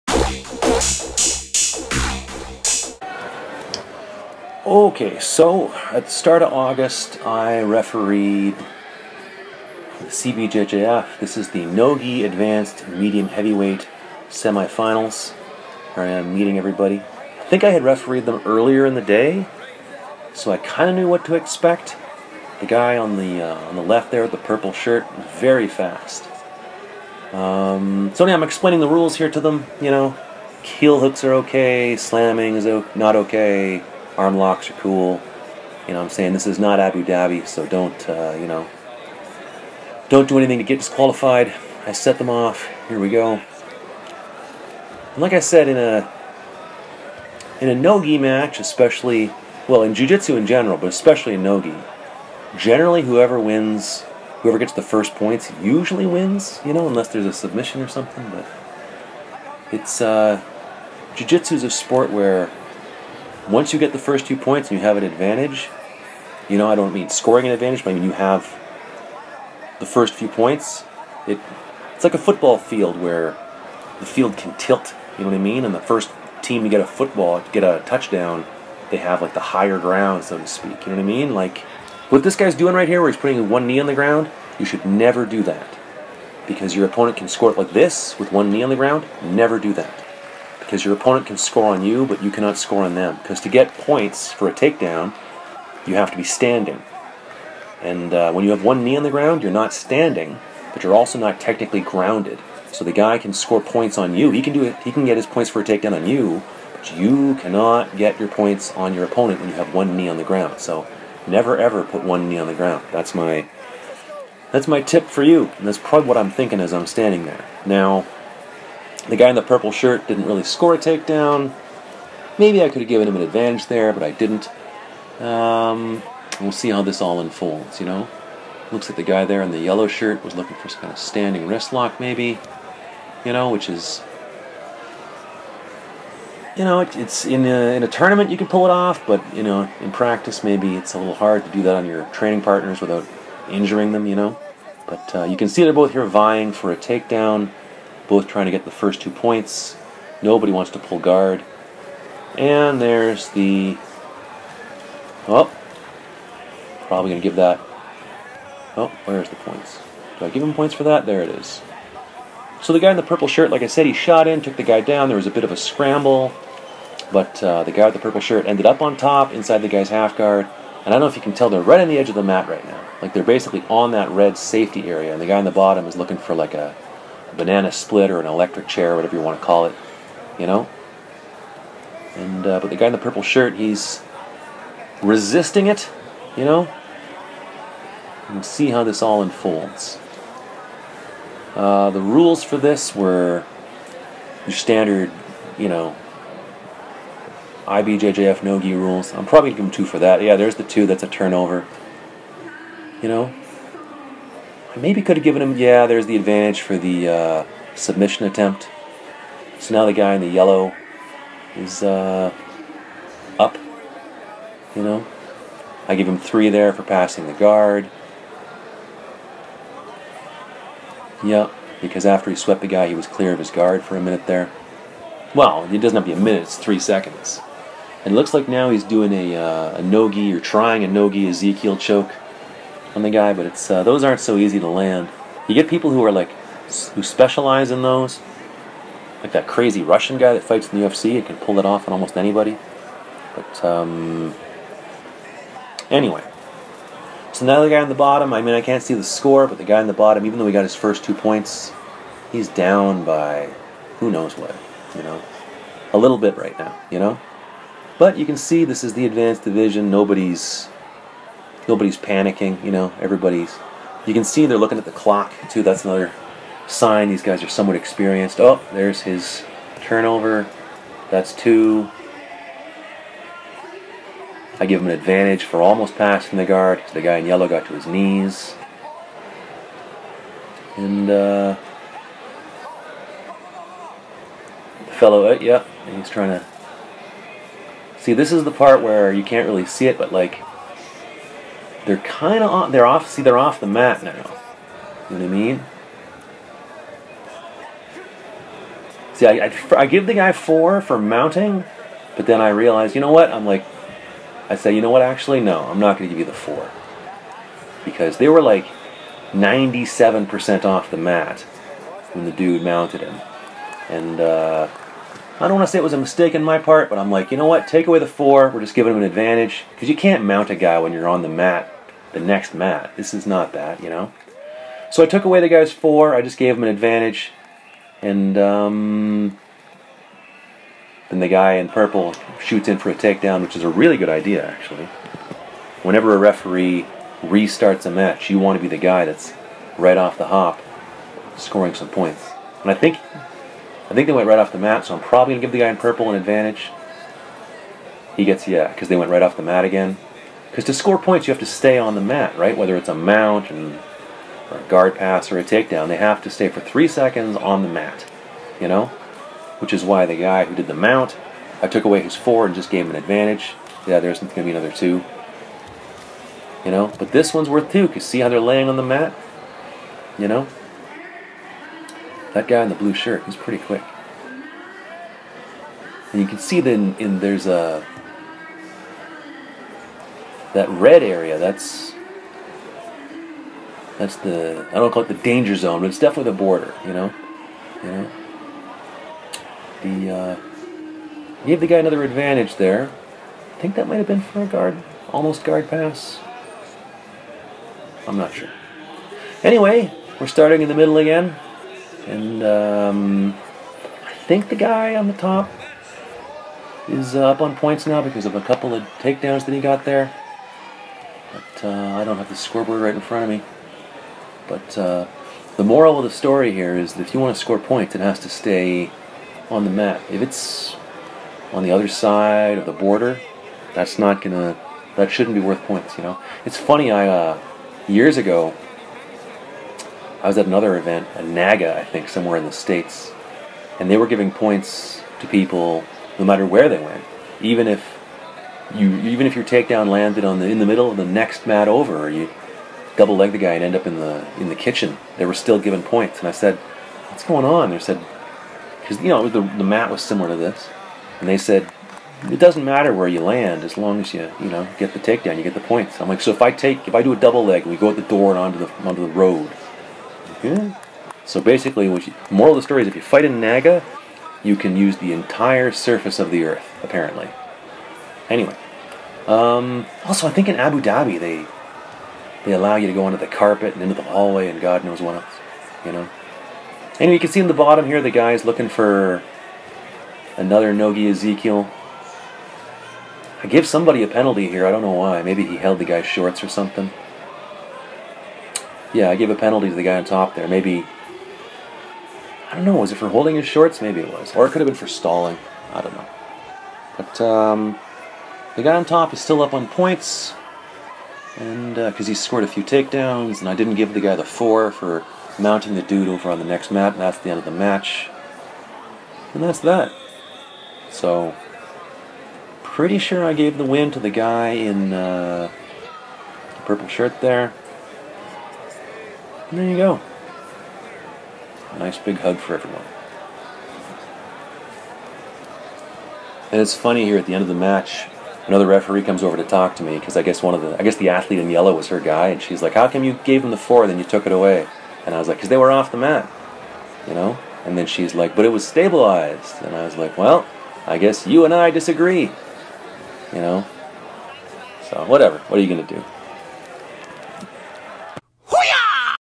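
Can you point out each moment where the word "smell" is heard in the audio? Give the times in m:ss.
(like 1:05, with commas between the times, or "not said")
not said.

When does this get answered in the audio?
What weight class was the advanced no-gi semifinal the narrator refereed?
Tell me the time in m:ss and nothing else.
0:12.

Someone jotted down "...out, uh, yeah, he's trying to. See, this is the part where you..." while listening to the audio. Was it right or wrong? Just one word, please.
right.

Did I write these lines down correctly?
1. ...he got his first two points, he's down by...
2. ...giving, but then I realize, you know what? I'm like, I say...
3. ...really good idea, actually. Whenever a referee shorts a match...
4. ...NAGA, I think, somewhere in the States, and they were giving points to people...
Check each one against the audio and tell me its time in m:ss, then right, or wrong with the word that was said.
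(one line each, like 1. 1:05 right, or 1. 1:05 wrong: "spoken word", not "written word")
1. 4:10 right
2. 5:00 wrong: "mounting", not "giving"
3. 5:33 wrong: "restarts", not "shorts"
4. 7:11 right.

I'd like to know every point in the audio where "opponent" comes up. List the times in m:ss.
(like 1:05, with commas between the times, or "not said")
1:26, 1:30, 1:49.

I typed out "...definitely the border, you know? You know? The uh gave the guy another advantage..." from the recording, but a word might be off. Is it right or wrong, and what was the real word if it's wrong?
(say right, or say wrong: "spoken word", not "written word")
right.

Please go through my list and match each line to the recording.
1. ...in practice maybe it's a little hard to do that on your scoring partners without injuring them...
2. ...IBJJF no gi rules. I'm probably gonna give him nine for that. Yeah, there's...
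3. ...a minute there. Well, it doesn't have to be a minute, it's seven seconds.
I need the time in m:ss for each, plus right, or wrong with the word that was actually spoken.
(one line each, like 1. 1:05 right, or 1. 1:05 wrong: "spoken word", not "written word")
1. 2:19 wrong: "training", not "scoring"
2. 3:17 wrong: "two", not "nine"
3. 3:43 wrong: "three", not "seven".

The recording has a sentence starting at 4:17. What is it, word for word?
But you can see this is the advanced division.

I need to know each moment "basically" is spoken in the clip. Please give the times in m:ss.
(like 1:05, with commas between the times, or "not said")
2:53, 7:41.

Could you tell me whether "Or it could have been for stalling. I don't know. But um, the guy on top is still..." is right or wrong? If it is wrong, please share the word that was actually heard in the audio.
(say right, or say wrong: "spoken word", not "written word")
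right.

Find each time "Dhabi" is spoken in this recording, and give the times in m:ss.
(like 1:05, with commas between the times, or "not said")
0:37, 7:50.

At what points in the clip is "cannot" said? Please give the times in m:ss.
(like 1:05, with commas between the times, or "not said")
1:32, 1:47.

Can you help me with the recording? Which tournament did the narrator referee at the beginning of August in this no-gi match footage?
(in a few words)
CBJJF.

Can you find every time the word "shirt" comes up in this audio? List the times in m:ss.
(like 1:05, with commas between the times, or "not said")
0:24, 1:59, 2:09, 2:43, 2:48, 3:03, 6:12, 8:36.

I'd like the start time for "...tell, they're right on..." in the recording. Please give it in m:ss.
2:51.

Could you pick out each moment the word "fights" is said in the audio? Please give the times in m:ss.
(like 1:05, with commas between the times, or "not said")
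4:00, 7:43.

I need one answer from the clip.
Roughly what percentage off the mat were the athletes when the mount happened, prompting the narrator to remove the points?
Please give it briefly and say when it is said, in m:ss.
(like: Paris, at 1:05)
97%, at 5:09.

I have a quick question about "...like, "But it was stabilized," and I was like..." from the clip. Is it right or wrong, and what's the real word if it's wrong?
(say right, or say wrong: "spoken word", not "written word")
right.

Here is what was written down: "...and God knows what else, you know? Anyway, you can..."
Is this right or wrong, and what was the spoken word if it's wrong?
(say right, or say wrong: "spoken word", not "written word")
right.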